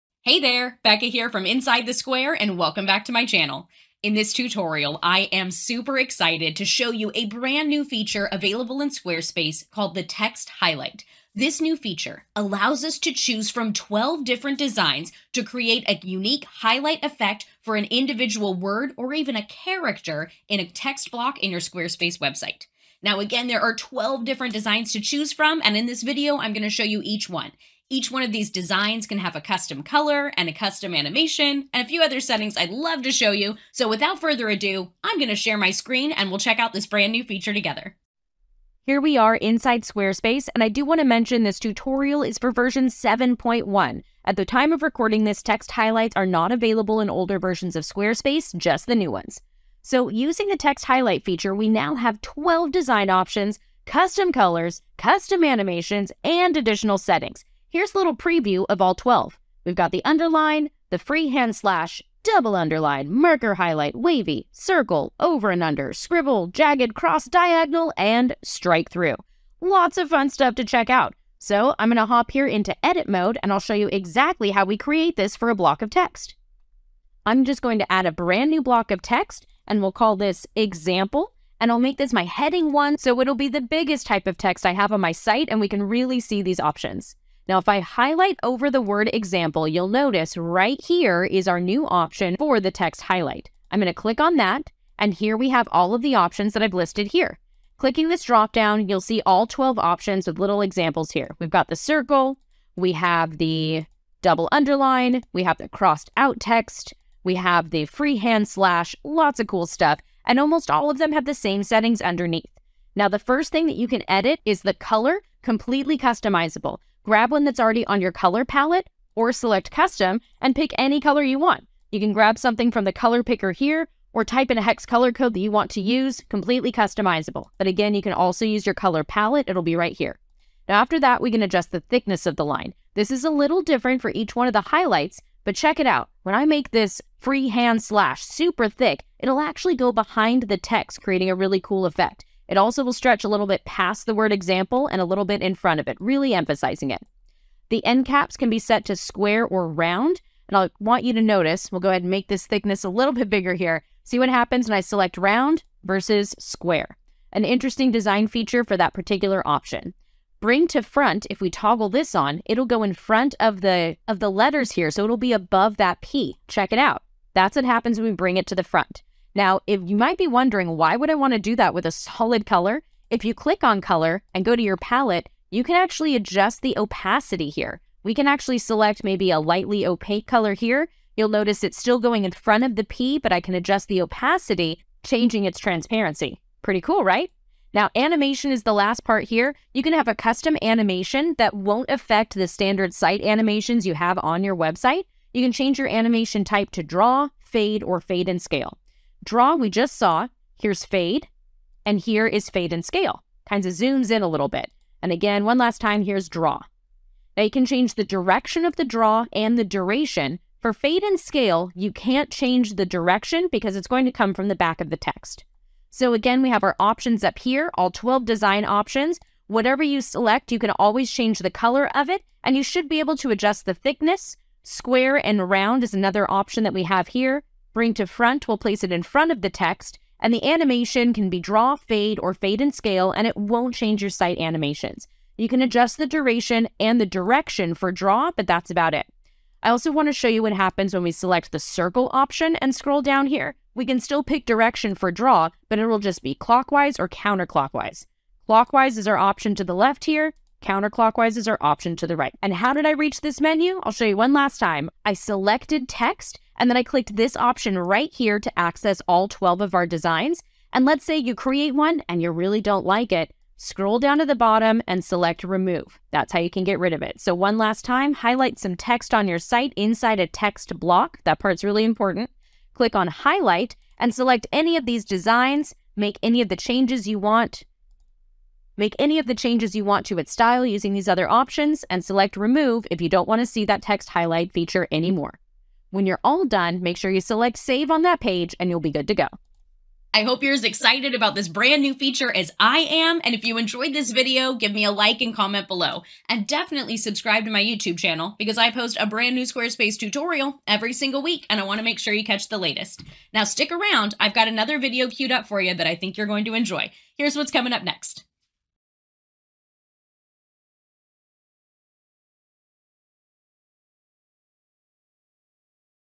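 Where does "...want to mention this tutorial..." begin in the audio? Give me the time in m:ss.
0:40.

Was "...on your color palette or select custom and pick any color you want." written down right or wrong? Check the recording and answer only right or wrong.
right.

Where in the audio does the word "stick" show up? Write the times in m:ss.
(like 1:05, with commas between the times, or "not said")
5:03.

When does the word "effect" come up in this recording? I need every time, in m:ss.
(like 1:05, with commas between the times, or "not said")
0:17, 2:21.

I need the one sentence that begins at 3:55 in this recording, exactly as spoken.
You can adjust the duration and the direction for draw, but that's about it.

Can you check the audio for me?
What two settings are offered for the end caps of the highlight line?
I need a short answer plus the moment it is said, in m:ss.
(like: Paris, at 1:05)
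square or round, at 2:28.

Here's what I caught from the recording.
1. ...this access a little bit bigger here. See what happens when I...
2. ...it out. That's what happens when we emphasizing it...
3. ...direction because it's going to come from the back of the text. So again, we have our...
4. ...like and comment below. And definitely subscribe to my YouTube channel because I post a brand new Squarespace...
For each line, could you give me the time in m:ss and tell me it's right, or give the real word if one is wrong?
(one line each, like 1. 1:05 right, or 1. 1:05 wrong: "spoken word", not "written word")
1. 2:32 wrong: "thickness", not "access"
2. 2:46 wrong: "bring", not "emphasizing"
3. 3:32 right
4. 4:54 right.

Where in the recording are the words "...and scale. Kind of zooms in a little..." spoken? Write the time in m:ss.
3:22.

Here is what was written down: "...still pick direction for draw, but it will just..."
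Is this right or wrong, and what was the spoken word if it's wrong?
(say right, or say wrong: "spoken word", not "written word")
right.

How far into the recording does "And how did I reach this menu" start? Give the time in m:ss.
4:12.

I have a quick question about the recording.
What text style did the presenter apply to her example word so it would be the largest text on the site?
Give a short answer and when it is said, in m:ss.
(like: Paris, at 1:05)
heading one, at 1:22.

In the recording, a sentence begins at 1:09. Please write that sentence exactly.
Lots of fun stuff to check out.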